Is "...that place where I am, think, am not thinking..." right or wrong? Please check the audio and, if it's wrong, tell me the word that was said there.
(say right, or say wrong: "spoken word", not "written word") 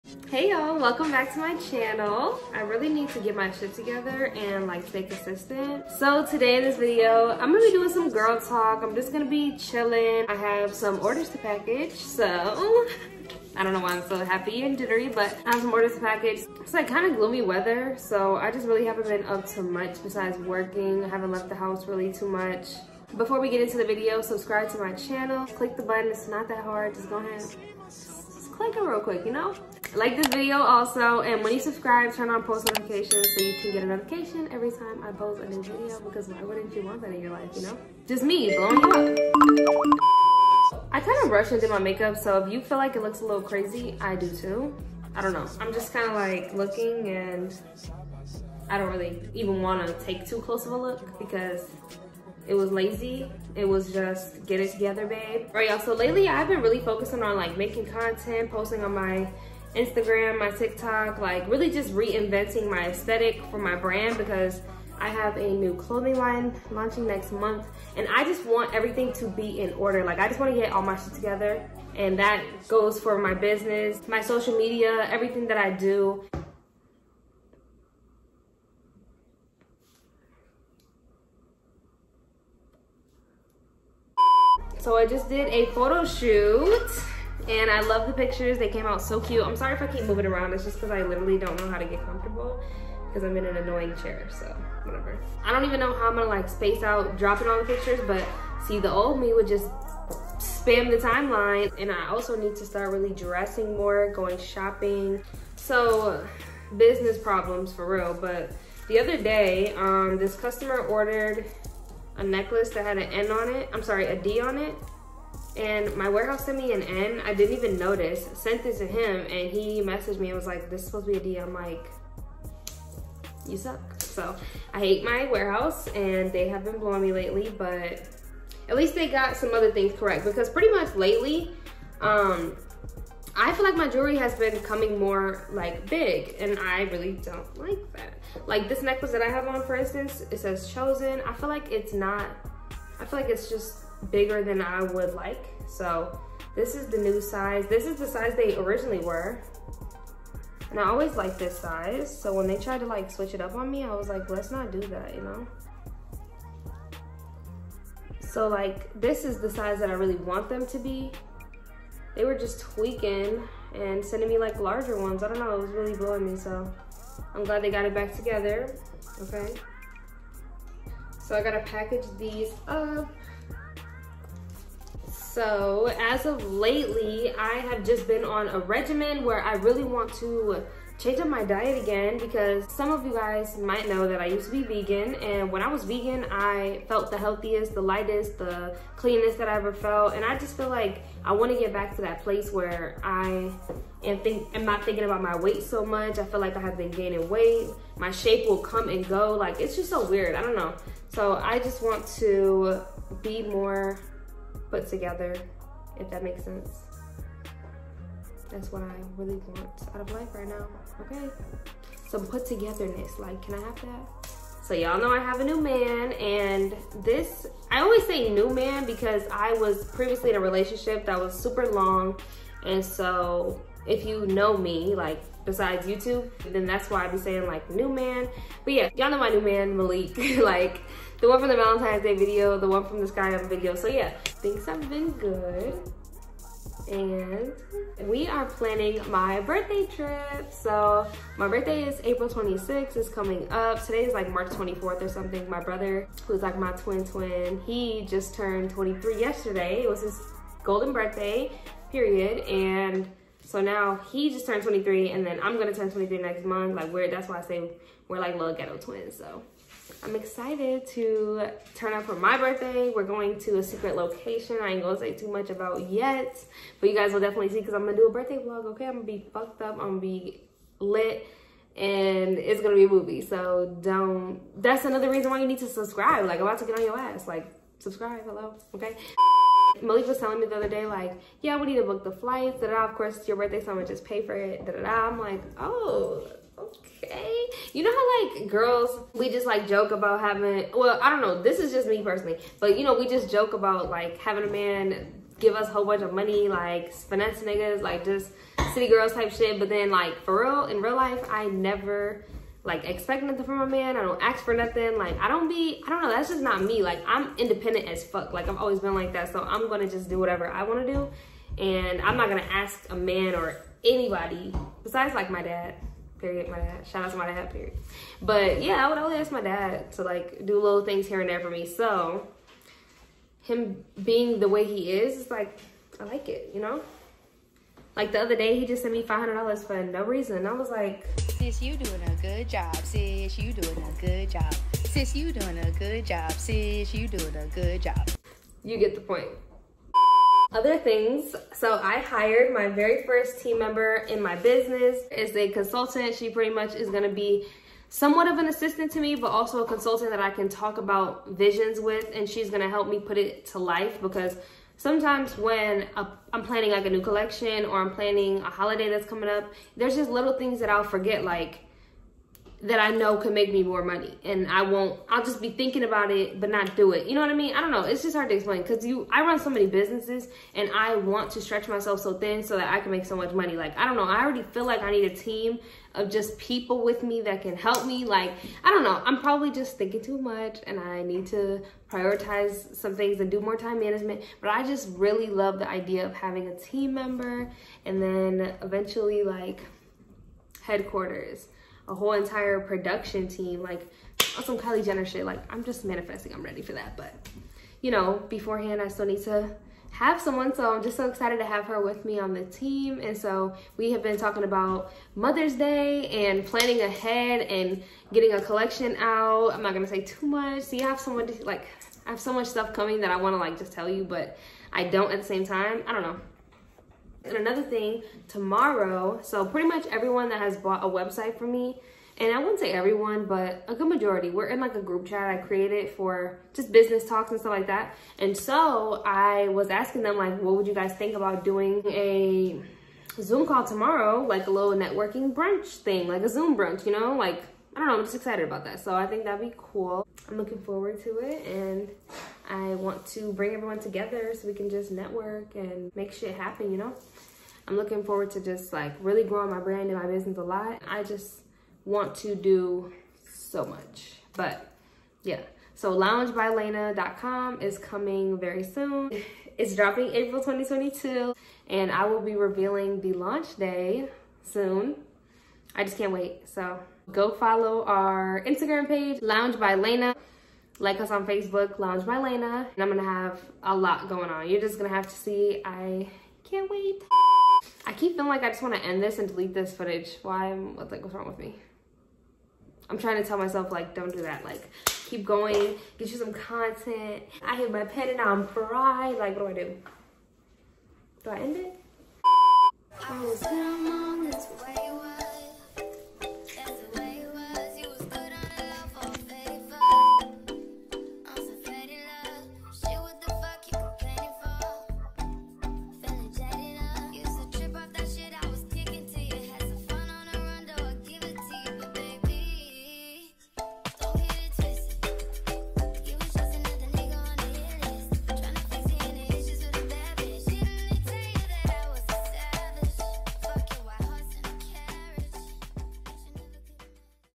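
right.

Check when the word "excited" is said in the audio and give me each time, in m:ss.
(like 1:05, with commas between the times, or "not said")
4:20, 6:41, 7:18.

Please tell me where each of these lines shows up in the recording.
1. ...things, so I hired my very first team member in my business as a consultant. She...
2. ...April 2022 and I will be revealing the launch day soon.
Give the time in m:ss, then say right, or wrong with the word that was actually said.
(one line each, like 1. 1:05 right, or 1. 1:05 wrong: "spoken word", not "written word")
1. 5:40 right
2. 7:40 right.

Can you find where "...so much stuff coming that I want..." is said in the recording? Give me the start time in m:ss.
6:52.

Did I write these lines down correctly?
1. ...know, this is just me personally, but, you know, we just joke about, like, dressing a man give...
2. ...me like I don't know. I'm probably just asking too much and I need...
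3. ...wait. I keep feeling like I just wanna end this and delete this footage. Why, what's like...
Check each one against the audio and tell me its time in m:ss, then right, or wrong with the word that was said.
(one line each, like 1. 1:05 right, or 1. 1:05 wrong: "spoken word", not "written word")
1. 4:51 wrong: "having", not "dressing"
2. 6:17 wrong: "thinking", not "asking"
3. 7:56 right.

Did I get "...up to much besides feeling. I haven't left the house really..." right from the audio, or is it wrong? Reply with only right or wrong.
wrong.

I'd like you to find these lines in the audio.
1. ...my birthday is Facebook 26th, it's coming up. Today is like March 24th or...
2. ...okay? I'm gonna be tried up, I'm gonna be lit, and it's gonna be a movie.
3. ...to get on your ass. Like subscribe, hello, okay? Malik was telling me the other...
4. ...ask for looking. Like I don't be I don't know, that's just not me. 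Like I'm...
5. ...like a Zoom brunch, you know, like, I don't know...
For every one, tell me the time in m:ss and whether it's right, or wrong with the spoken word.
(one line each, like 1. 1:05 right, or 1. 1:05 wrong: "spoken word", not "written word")
1. 4:01 wrong: "April", not "Facebook"
2. 4:28 wrong: "fucked", not "tried"
3. 4:36 right
4. 5:04 wrong: "nothing", not "looking"
5. 7:16 right.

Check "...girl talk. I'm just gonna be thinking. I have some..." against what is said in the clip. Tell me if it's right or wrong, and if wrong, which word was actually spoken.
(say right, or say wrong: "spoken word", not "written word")
wrong: "chilling", not "thinking".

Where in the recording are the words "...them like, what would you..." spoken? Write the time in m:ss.
7:10.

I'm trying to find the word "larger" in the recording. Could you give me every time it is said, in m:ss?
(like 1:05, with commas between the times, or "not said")
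2:44.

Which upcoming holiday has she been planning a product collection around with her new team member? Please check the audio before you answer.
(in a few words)
Mother's Day.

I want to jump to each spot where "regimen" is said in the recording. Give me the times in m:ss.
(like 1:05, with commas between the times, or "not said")
2:58.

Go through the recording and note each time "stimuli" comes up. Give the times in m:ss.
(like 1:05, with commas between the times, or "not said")
not said.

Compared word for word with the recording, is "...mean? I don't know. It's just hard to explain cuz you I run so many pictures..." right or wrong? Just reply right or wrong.
wrong.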